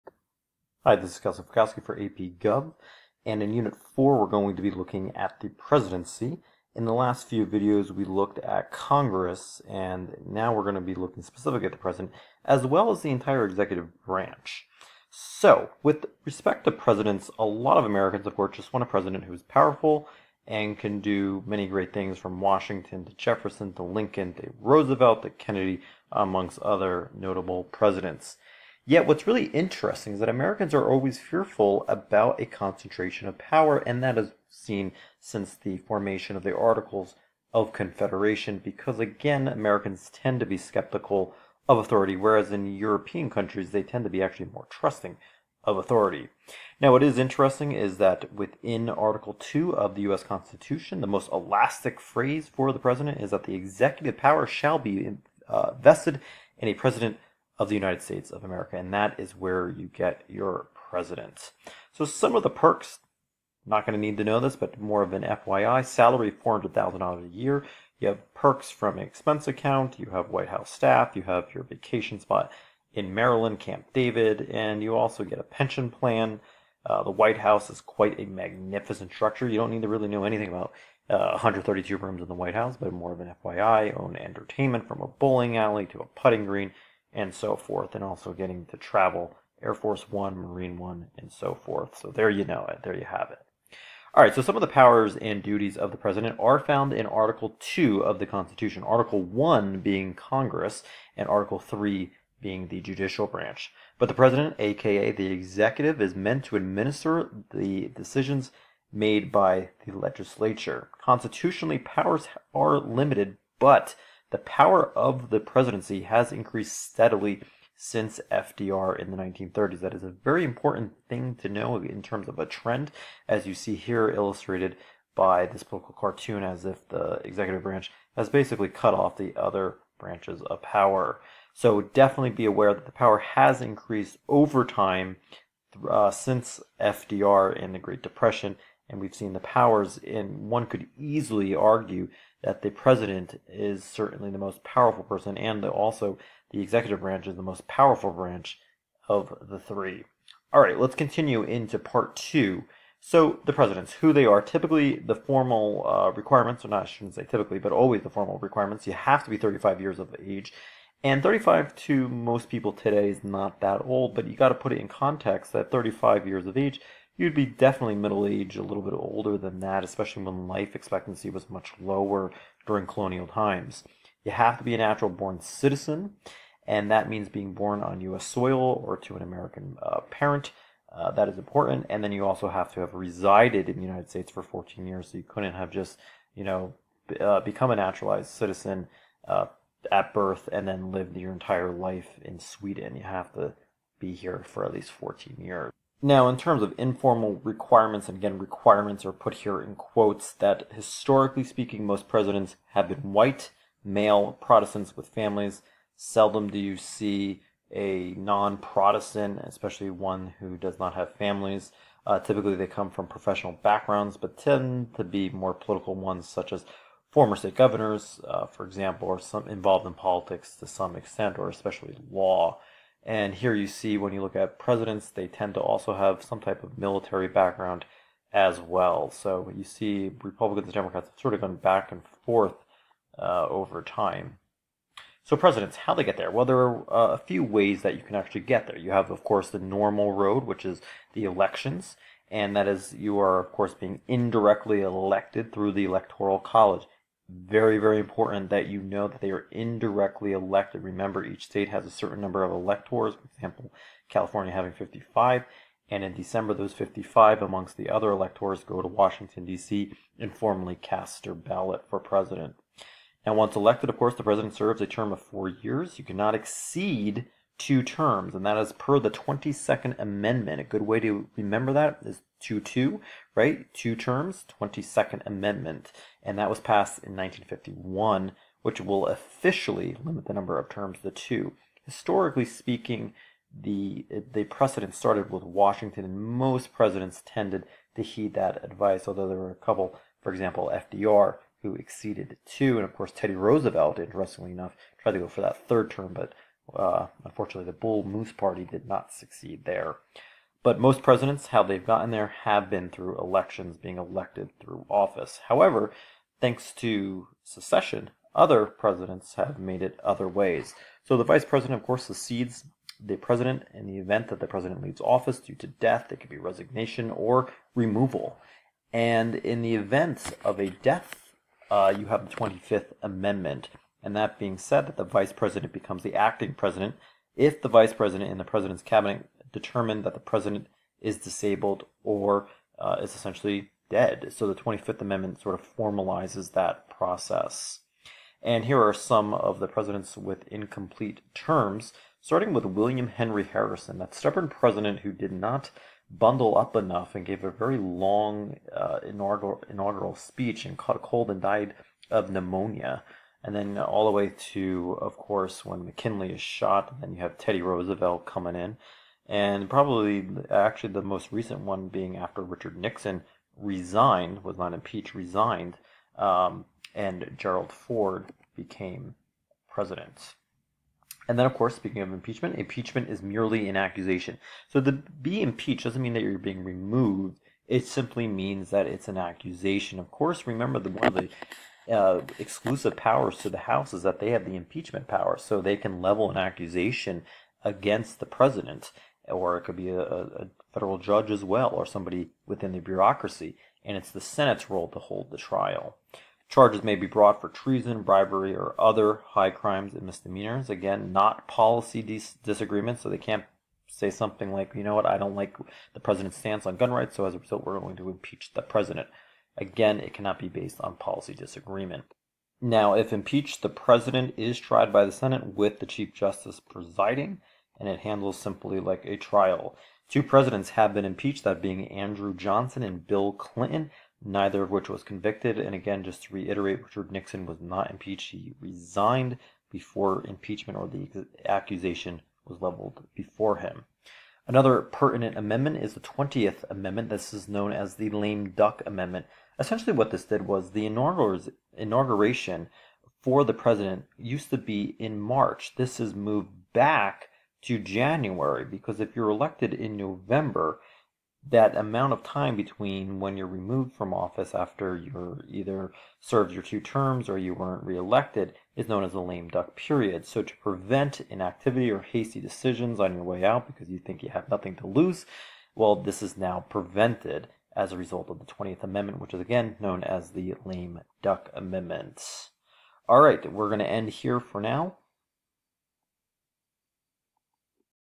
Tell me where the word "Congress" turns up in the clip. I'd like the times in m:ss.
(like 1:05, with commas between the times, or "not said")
0:08, 1:40.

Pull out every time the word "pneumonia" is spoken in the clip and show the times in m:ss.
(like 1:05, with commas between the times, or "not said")
5:52.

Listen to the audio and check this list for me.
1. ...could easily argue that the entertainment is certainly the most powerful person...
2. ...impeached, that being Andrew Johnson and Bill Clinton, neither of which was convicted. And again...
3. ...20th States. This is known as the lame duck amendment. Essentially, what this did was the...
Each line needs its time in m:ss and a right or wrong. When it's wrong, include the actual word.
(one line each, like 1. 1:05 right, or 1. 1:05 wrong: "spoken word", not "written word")
1. 2:20 wrong: "president", not "entertainment"
2. 7:01 right
3. 7:15 wrong: "Amendment", not "States".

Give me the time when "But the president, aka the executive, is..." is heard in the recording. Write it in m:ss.
1:43.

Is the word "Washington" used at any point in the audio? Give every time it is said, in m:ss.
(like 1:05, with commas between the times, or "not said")
0:22, 4:18, 4:45.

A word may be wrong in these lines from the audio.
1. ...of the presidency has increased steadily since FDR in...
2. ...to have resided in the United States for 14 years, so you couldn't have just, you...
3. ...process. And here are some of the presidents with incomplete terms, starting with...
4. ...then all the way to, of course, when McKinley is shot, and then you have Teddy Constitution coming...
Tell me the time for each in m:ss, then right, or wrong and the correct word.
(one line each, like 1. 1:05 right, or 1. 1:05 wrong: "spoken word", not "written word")
1. 1:54 right
2. 3:02 right
3. 5:36 right
4. 5:53 wrong: "Roosevelt", not "Constitution".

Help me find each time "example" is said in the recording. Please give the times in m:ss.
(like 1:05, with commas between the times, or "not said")
3:38, 4:13, 4:50.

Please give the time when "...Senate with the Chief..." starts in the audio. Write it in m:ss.
6:55.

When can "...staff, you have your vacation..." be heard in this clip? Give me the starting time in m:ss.
1:10.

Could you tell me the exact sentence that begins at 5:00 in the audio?
But most presidents, how they've gotten there, have been through elections, being elected through office.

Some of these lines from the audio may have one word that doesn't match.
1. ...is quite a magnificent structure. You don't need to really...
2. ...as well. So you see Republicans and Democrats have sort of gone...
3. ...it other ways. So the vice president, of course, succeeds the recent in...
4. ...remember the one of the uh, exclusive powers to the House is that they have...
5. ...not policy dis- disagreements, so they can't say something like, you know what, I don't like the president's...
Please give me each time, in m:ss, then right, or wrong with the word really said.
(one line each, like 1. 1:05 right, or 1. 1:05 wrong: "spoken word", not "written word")
1. 1:17 right
2. 3:48 right
3. 5:09 wrong: "president", not "recent"
4. 6:20 right
5. 6:41 right.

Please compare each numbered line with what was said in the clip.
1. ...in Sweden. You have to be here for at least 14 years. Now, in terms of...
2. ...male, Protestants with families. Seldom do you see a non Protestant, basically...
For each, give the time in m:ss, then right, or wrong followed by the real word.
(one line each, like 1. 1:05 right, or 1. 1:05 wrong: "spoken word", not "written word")
1. 3:12 right
2. 3:23 wrong: "especially", not "basically".